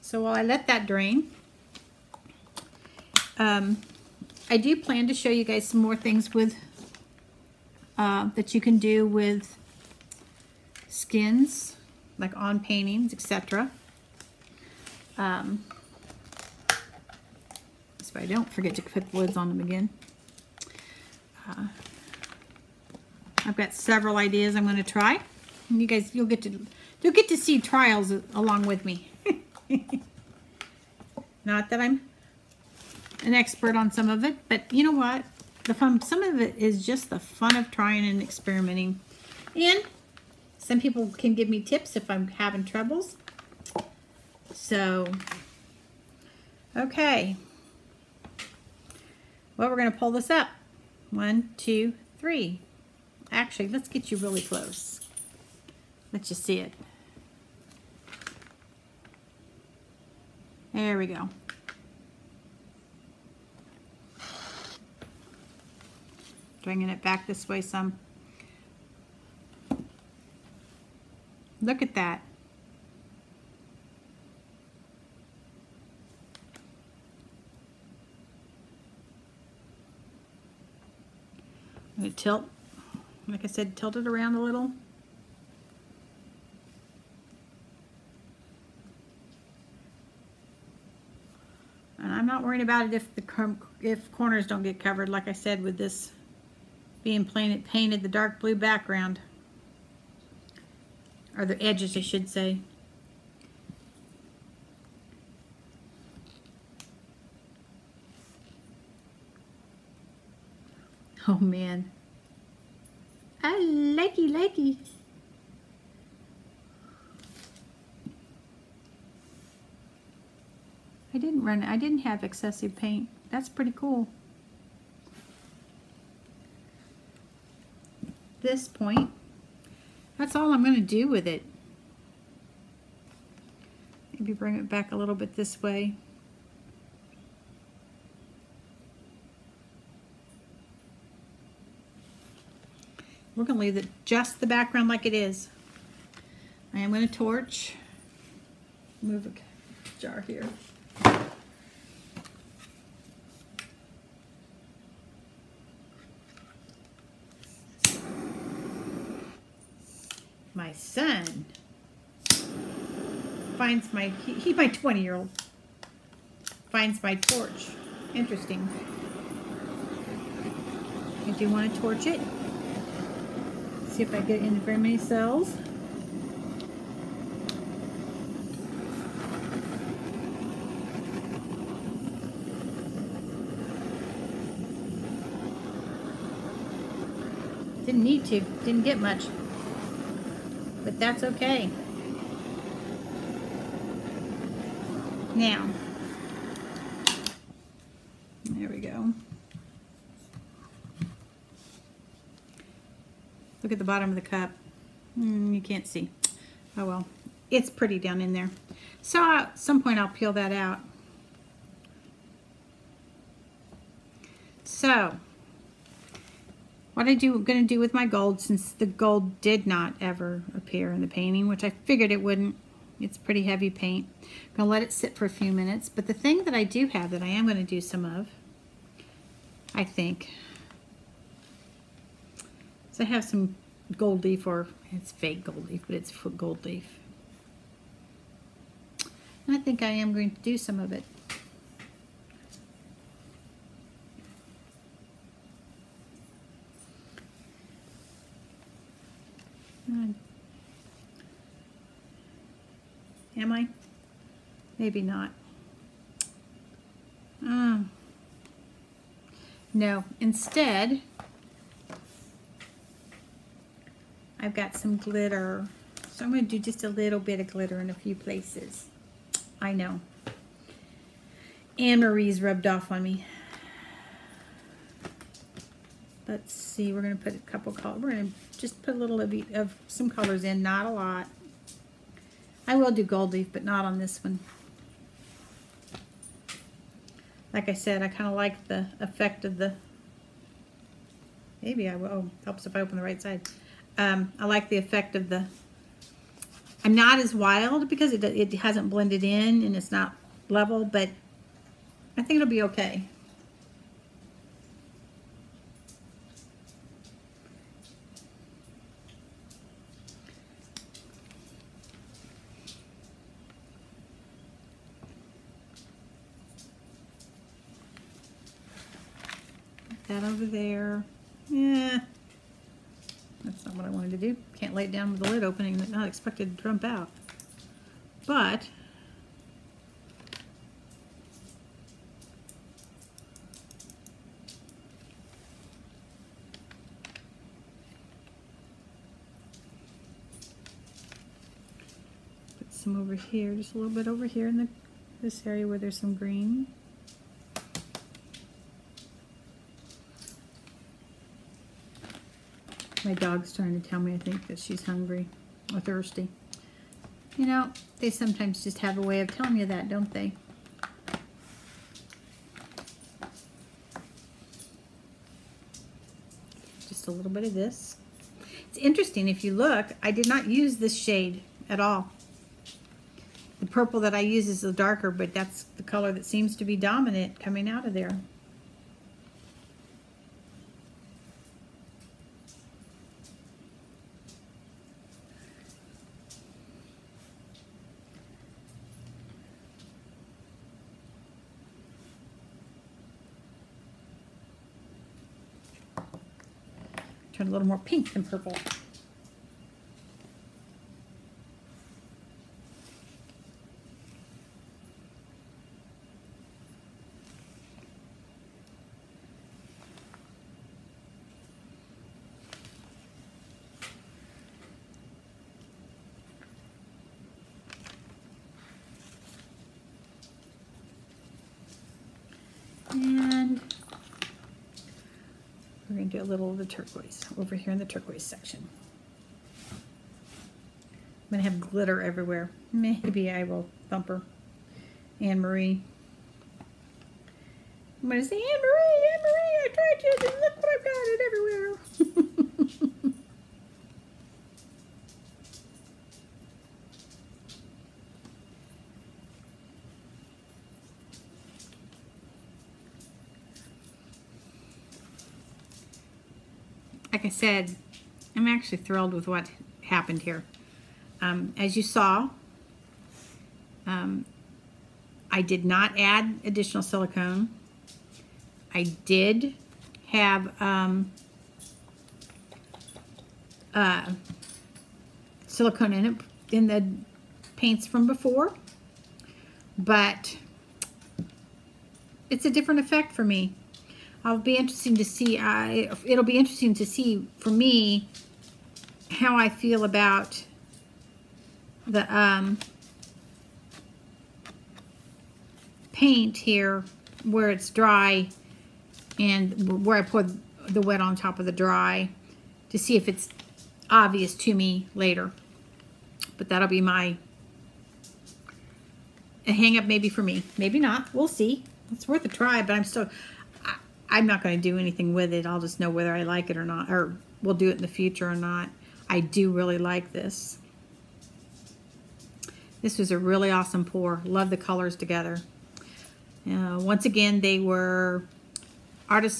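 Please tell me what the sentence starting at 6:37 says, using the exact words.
Turn a little more pink than purple.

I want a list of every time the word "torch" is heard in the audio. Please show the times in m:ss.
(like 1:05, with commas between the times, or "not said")
2:27, 2:47, 2:51.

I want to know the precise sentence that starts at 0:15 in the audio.
Um, so I don't forget to put the lids on them again.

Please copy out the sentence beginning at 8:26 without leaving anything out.
But that'll be my a hang up maybe for me.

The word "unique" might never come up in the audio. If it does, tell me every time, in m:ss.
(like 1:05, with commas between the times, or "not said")
not said.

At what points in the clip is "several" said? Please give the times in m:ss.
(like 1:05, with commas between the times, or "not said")
0:23.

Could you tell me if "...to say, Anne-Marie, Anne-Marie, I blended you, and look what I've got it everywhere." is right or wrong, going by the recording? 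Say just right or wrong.
wrong.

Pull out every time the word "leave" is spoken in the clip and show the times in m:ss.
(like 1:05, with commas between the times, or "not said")
2:23.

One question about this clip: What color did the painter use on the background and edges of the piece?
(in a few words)
Dark blue.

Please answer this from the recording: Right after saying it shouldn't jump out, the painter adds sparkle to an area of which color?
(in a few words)
Green.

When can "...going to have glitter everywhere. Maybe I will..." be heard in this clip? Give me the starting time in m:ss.
7:11.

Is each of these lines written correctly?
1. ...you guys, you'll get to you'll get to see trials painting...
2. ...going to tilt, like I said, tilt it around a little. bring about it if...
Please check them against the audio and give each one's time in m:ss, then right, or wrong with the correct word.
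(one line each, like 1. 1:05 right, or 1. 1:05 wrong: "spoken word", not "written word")
1. 0:25 wrong: "along", not "painting"
2. 1:22 wrong: "worrying", not "bring".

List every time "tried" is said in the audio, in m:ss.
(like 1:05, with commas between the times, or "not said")
7:19.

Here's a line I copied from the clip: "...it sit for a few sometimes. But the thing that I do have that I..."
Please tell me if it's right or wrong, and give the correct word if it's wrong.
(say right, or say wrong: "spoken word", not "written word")
wrong: "minutes", not "sometimes".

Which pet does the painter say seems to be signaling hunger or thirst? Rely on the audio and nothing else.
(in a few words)
Dog.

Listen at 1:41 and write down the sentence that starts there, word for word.
Or the edges, I should say.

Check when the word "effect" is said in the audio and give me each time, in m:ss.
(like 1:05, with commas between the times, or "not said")
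4:48, 4:54, 8:02.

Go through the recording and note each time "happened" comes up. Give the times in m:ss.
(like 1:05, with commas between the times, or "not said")
7:39.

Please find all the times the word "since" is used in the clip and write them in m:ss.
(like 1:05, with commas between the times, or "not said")
3:38.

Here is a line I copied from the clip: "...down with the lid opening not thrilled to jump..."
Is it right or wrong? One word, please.
wrong.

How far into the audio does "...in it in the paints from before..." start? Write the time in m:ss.
7:55.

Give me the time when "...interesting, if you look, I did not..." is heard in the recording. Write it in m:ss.
6:08.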